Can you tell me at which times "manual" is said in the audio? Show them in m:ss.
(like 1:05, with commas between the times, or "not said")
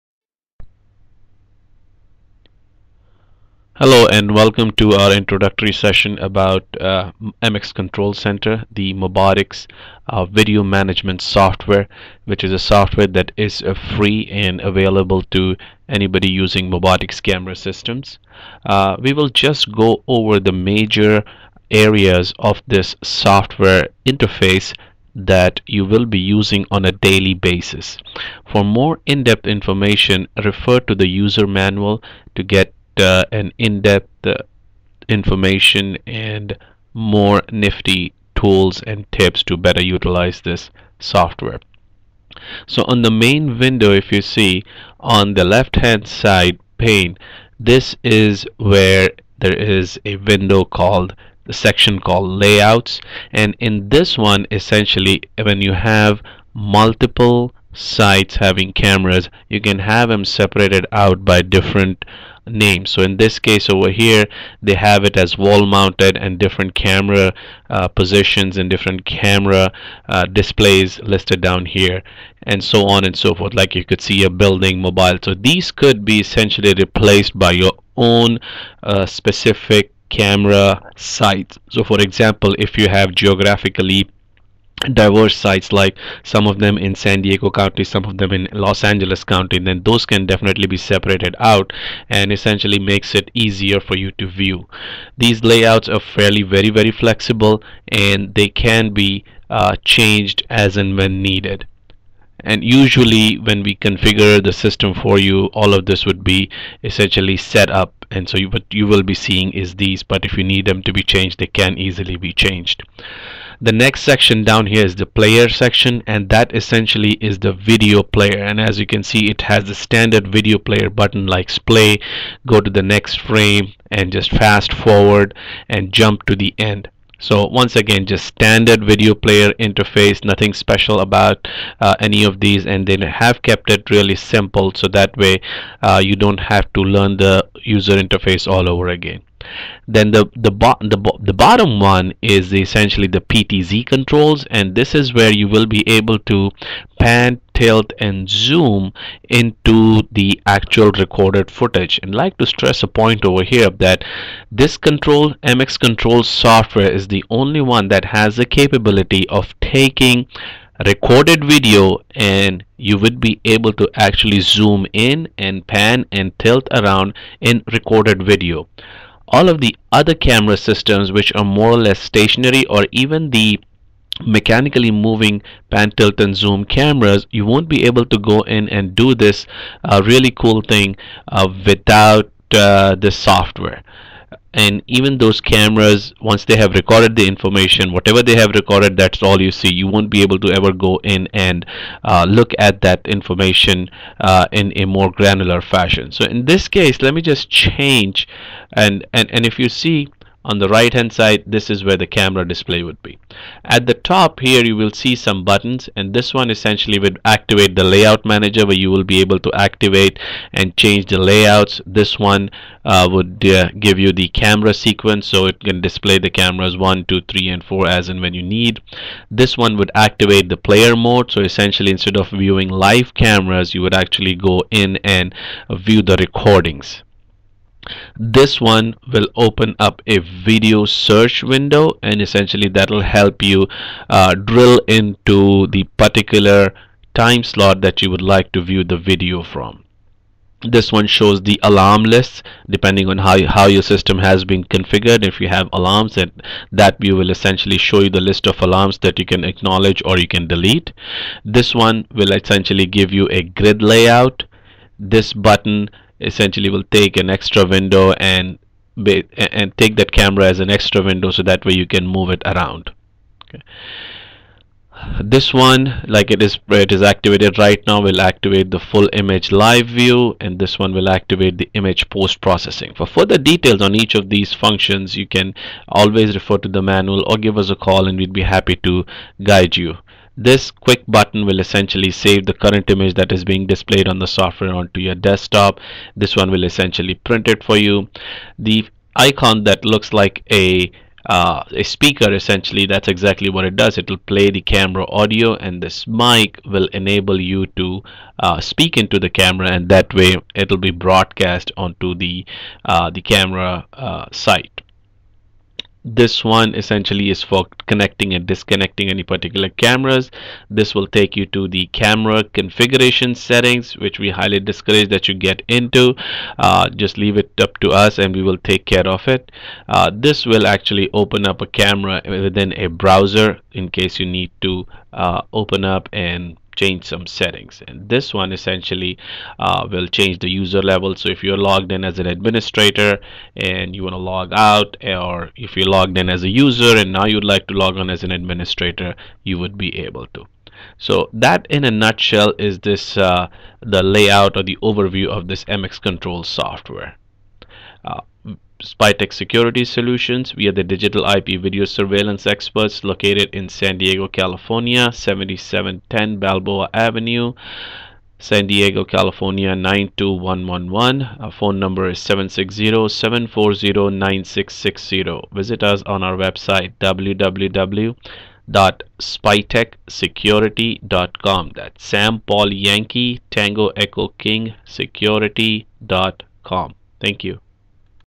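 0:31, 4:36.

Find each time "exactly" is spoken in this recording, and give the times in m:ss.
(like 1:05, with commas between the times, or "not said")
4:53.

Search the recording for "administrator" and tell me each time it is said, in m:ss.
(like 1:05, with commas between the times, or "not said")
5:32, 5:38.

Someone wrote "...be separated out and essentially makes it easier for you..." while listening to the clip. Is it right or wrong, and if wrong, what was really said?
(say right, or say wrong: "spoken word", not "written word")
right.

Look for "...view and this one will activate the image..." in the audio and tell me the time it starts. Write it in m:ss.
4:29.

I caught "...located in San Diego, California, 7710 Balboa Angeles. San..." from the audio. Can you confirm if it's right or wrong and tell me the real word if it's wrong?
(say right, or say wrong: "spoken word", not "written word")
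wrong: "Avenue", not "Angeles".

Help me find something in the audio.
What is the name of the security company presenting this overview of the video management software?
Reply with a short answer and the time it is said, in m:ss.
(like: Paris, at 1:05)
Spytek Security Solutions, at 5:48.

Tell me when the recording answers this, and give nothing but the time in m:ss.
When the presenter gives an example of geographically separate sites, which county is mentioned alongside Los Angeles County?
1:26.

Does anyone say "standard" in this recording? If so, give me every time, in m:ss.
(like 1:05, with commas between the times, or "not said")
1:59, 2:08.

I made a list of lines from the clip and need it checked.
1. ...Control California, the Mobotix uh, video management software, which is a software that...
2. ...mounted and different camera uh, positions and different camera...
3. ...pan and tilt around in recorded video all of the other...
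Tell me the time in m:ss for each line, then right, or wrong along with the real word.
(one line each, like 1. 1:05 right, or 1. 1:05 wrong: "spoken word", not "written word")
1. 0:07 wrong: "Center", not "California"
2. 1:05 right
3. 2:45 right.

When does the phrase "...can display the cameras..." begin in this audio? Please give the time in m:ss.
3:35.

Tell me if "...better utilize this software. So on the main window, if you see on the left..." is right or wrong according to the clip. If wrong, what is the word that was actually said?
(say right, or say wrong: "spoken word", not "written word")
right.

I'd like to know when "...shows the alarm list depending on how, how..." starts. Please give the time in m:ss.
4:01.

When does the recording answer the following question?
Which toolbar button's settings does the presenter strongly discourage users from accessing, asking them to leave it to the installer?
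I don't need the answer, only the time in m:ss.
5:11.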